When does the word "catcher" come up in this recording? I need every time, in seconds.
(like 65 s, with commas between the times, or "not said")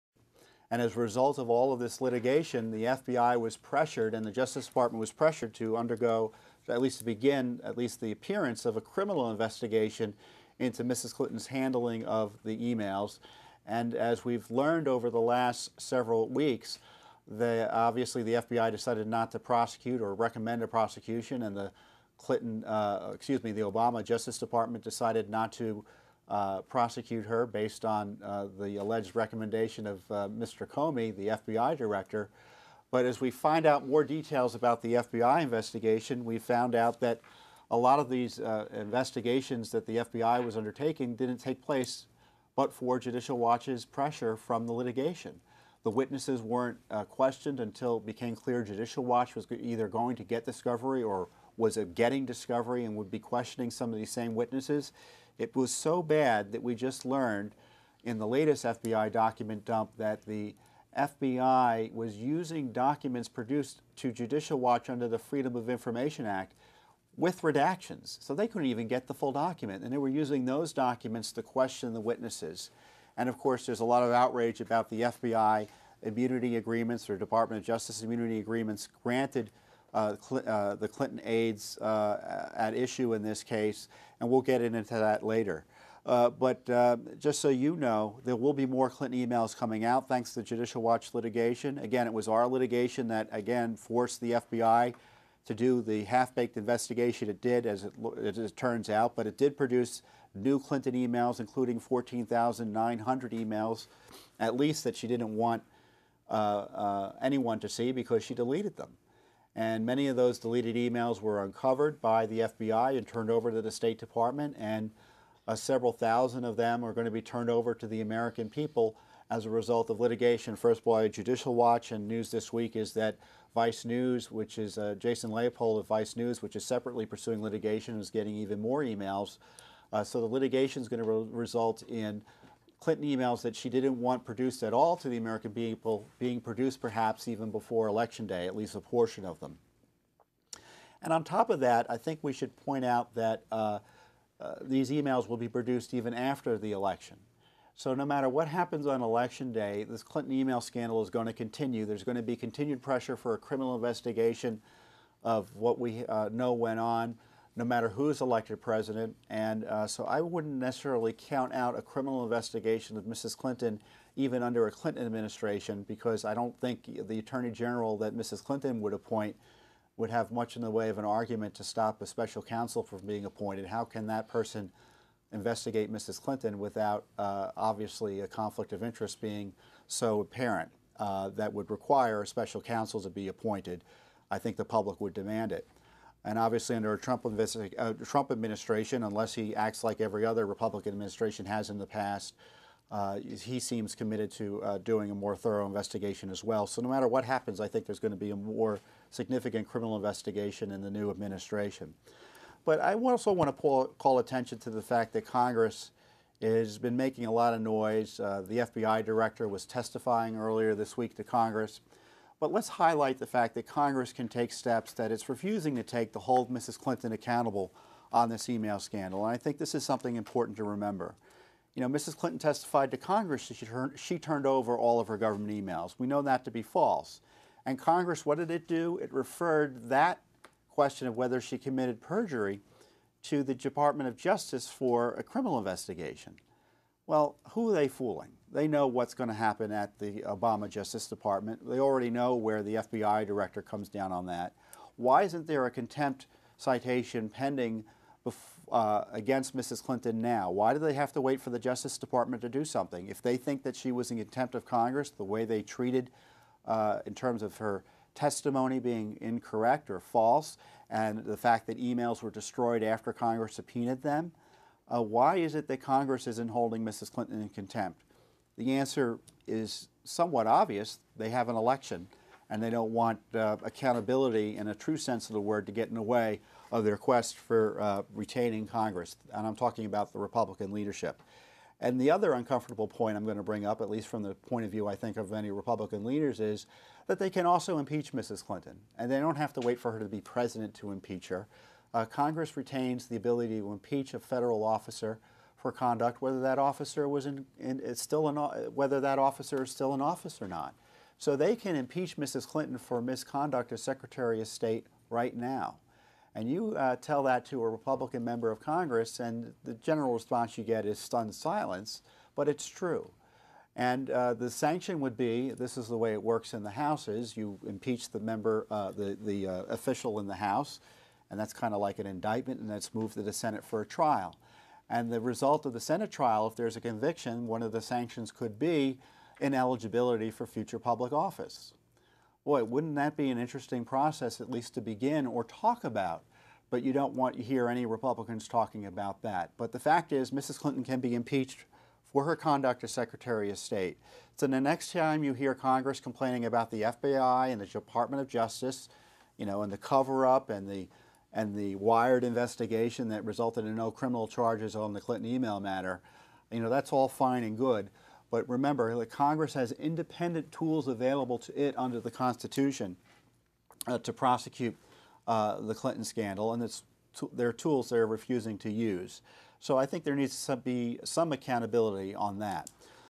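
not said.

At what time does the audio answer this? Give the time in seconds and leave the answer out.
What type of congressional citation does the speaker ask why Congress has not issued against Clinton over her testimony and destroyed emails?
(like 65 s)
245 s.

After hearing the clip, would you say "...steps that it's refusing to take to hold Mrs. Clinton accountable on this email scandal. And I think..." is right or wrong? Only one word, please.
right.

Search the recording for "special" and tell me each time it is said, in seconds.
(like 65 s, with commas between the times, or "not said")
172 s, 182 s.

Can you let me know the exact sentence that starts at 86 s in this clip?
Uh, but uh, just so you know, there will be more Clinton emails coming out thanks to the Judicial Watch litigation.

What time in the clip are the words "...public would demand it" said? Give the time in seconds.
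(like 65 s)
184 s.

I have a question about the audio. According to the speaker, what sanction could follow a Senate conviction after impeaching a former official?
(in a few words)
ineligibility for future public office.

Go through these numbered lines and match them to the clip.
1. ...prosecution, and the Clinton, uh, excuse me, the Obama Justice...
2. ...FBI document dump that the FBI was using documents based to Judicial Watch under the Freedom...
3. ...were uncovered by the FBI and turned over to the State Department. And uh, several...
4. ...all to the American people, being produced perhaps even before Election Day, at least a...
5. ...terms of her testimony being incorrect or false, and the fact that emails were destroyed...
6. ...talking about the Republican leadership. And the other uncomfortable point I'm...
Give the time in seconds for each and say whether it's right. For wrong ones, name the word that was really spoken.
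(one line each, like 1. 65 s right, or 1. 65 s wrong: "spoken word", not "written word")
1. 20 s right
2. 58 s wrong: "produced", not "based"
3. 111 s right
4. 134 s right
5. 257 s right
6. 279 s right.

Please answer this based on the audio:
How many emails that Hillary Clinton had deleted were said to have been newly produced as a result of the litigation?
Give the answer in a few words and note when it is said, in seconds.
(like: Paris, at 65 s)
14,900, at 101 s.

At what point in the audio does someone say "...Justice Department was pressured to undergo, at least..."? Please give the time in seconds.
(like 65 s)
4 s.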